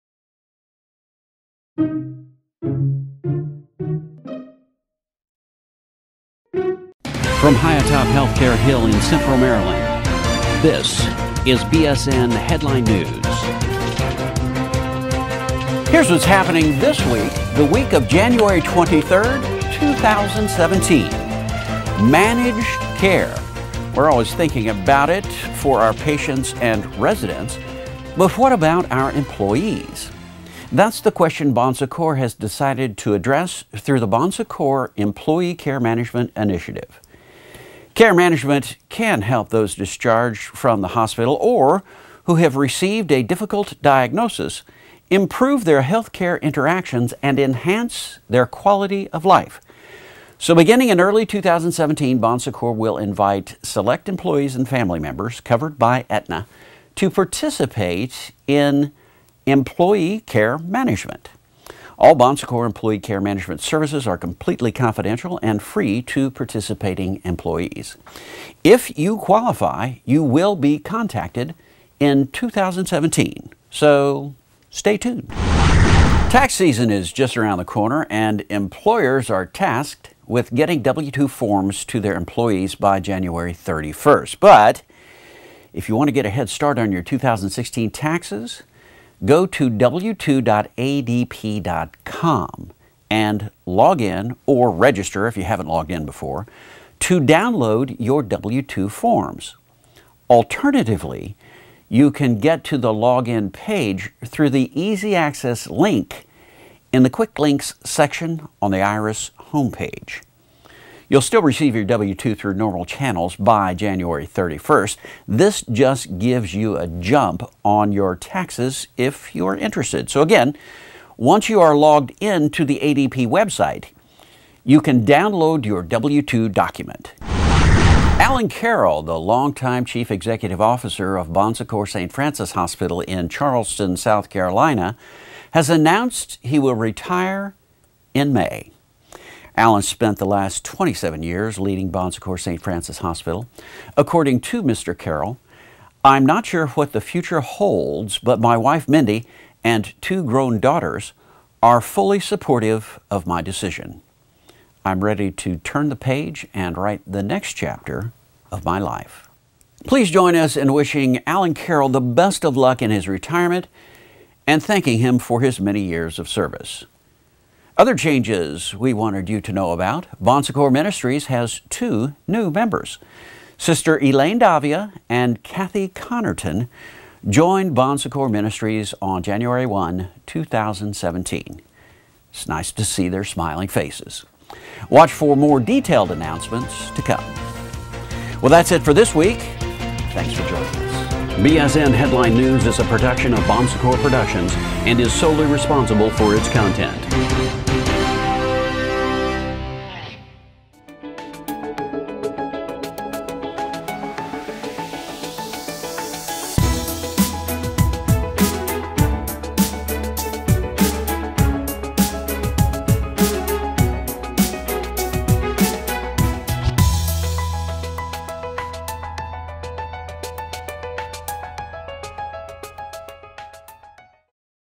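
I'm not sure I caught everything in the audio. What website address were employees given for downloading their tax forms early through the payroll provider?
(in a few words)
w2.adp.com.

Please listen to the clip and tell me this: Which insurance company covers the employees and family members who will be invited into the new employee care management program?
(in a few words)
Aetna.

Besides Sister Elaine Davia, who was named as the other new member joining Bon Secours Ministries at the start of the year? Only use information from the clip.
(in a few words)
Kathy Connerton.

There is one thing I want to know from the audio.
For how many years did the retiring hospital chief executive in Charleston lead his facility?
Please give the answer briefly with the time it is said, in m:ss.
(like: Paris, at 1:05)
27, at 2:20.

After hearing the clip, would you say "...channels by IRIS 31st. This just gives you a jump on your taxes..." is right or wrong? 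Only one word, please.
wrong.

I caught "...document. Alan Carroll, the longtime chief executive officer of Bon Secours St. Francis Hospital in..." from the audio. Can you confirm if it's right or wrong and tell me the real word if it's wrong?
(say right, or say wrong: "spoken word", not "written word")
right.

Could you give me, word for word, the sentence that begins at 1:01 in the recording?
All Bon Secours employee care management services are completely confidential and free to participating employees.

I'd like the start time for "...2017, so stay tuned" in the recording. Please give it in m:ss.
1:12.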